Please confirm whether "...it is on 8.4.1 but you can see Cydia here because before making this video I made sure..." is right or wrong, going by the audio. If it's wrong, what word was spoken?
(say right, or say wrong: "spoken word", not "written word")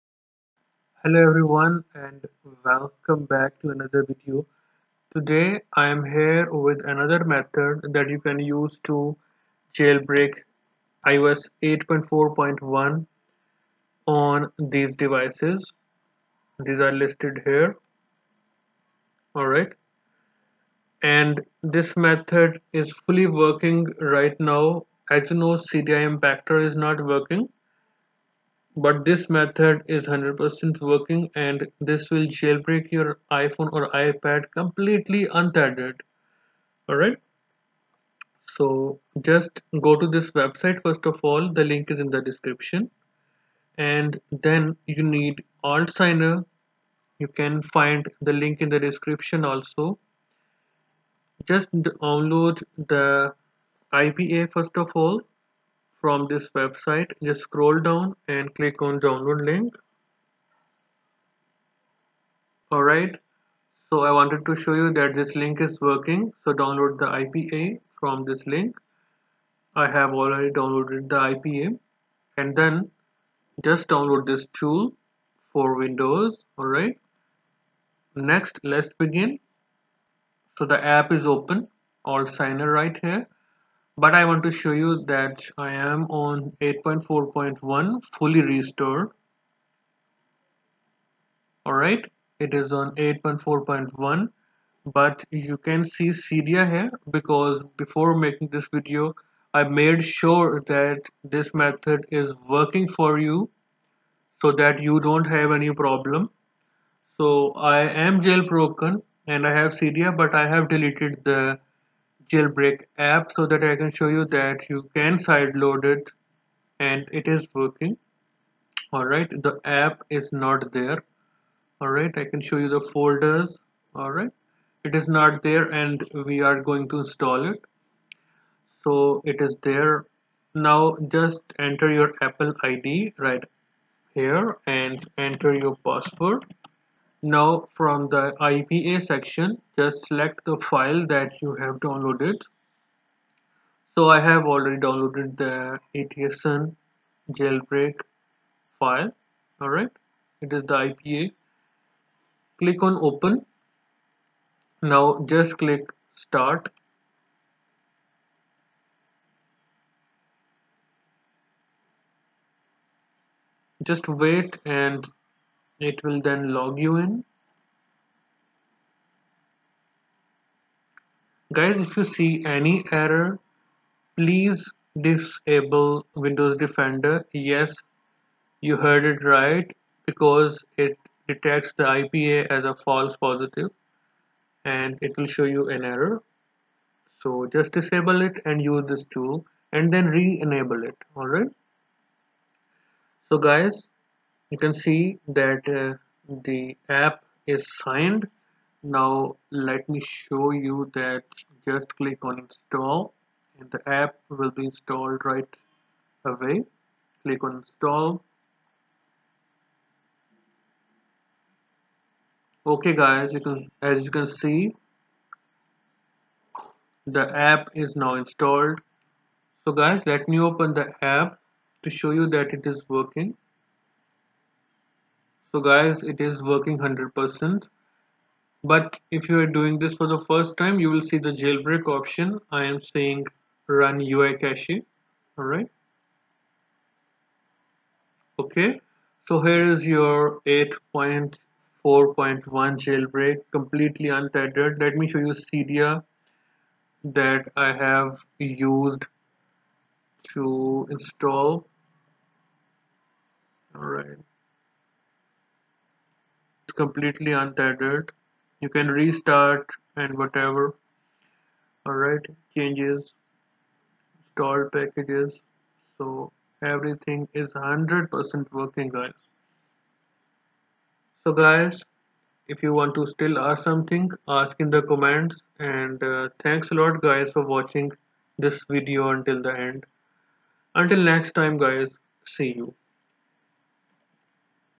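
right.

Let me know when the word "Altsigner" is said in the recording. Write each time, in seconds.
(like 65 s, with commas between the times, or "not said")
45 s, 82 s.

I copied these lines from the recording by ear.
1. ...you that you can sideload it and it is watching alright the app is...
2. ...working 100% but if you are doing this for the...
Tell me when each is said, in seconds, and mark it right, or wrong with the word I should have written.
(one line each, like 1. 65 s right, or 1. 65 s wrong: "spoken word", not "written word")
1. 114 s wrong: "working", not "watching"
2. 226 s right.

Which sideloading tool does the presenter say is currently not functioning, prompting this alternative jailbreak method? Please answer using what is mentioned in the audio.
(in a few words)
Cydia Impactor.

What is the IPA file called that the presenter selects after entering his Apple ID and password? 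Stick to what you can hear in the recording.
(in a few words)
Etason jailbreak.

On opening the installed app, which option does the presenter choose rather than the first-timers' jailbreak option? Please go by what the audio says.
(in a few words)
Run UI cache.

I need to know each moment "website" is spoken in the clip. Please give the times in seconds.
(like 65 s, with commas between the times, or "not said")
40 s, 56 s.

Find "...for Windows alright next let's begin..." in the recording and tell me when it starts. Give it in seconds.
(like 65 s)
75 s.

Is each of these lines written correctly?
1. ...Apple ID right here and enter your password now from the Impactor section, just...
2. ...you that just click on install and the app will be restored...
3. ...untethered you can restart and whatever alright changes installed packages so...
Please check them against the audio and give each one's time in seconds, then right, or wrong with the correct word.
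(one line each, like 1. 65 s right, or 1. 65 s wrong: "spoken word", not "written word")
1. 132 s wrong: "IPA", not "Impactor"
2. 200 s wrong: "installed", not "restored"
3. 257 s right.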